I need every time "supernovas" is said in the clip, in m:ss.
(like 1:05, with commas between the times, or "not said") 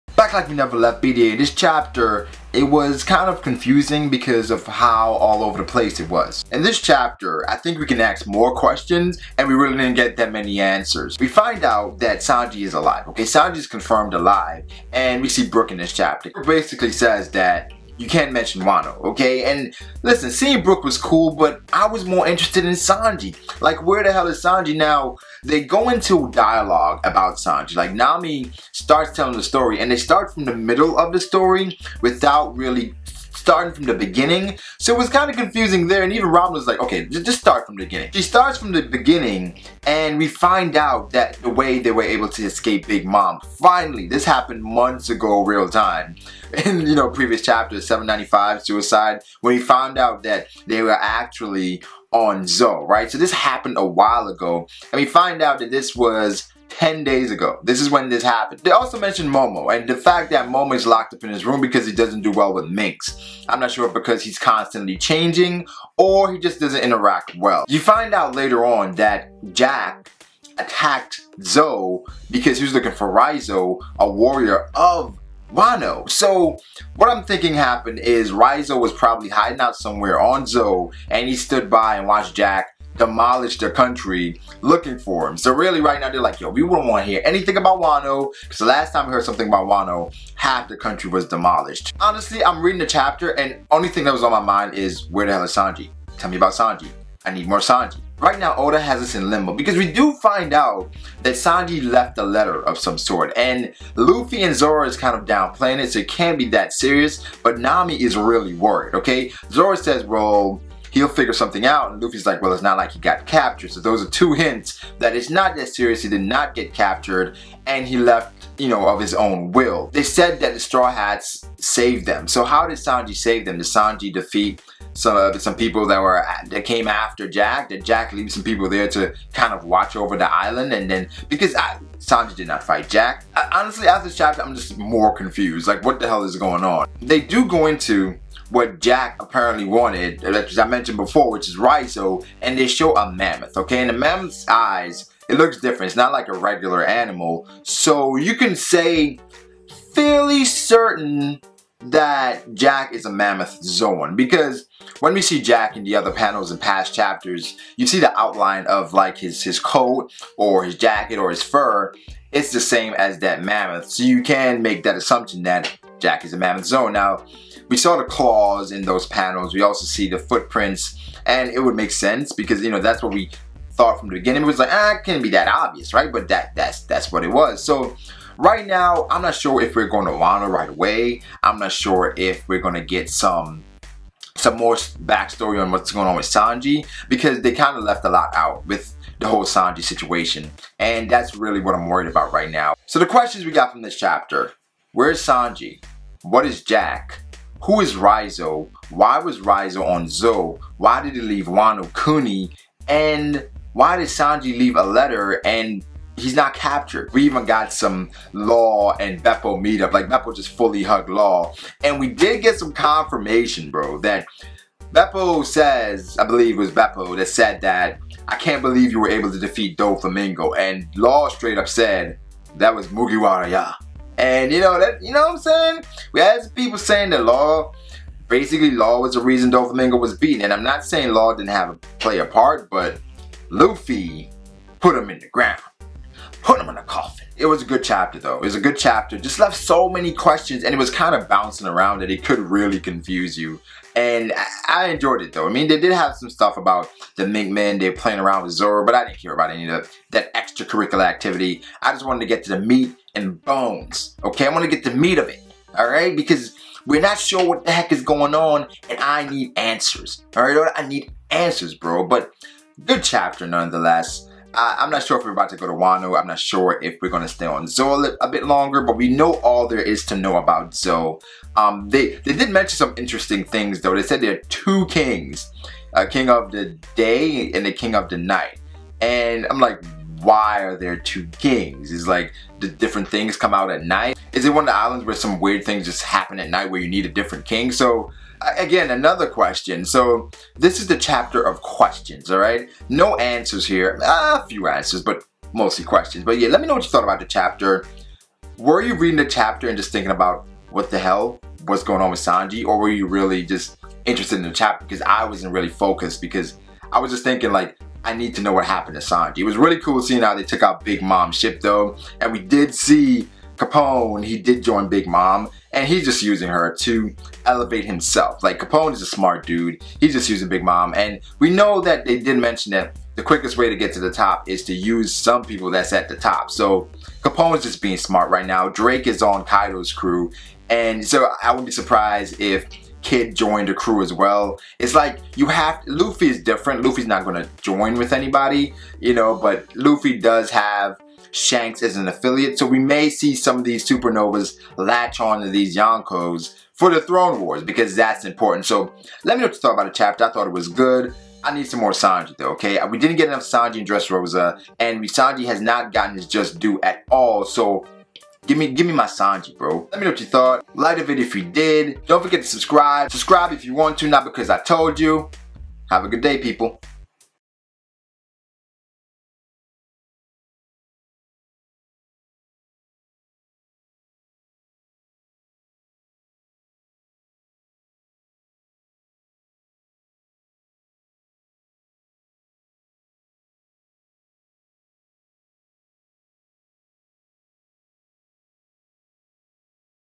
5:43.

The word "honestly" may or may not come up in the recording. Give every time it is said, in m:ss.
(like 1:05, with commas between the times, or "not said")
1:31, 2:13.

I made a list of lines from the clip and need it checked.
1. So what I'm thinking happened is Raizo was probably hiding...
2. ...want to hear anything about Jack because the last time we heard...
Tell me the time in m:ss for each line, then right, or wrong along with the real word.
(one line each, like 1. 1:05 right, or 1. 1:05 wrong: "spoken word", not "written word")
1. 1:16 right
2. 1:26 wrong: "Wano", not "Jack".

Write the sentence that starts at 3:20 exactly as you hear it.
Why did he leave Wano Kuni?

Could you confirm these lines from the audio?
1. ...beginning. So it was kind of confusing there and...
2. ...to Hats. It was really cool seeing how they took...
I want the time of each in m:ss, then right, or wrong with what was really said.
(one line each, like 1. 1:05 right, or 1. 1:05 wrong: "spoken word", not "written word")
1. 0:33 right
2. 5:08 wrong: "Sanji", not "Hats".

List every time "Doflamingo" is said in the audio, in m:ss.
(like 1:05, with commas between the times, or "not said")
3:39, 3:49.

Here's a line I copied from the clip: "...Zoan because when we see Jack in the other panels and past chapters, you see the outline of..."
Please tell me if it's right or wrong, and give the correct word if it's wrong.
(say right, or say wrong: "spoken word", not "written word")
right.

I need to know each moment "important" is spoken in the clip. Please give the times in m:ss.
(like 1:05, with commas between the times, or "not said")
5:48.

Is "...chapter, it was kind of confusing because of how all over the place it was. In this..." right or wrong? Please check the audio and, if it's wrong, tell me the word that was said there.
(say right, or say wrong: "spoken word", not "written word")
right.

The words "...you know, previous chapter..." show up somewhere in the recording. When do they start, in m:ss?
0:46.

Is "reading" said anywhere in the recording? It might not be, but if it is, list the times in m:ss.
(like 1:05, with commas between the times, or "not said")
1:32, 4:58.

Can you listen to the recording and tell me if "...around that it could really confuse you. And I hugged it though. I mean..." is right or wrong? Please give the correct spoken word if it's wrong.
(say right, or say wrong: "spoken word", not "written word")
wrong: "enjoyed", not "hugged".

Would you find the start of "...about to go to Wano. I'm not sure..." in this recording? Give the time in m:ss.
4:25.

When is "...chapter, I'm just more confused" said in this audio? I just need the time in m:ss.
2:14.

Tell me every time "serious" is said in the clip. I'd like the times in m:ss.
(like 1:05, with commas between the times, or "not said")
1:46, 1:55.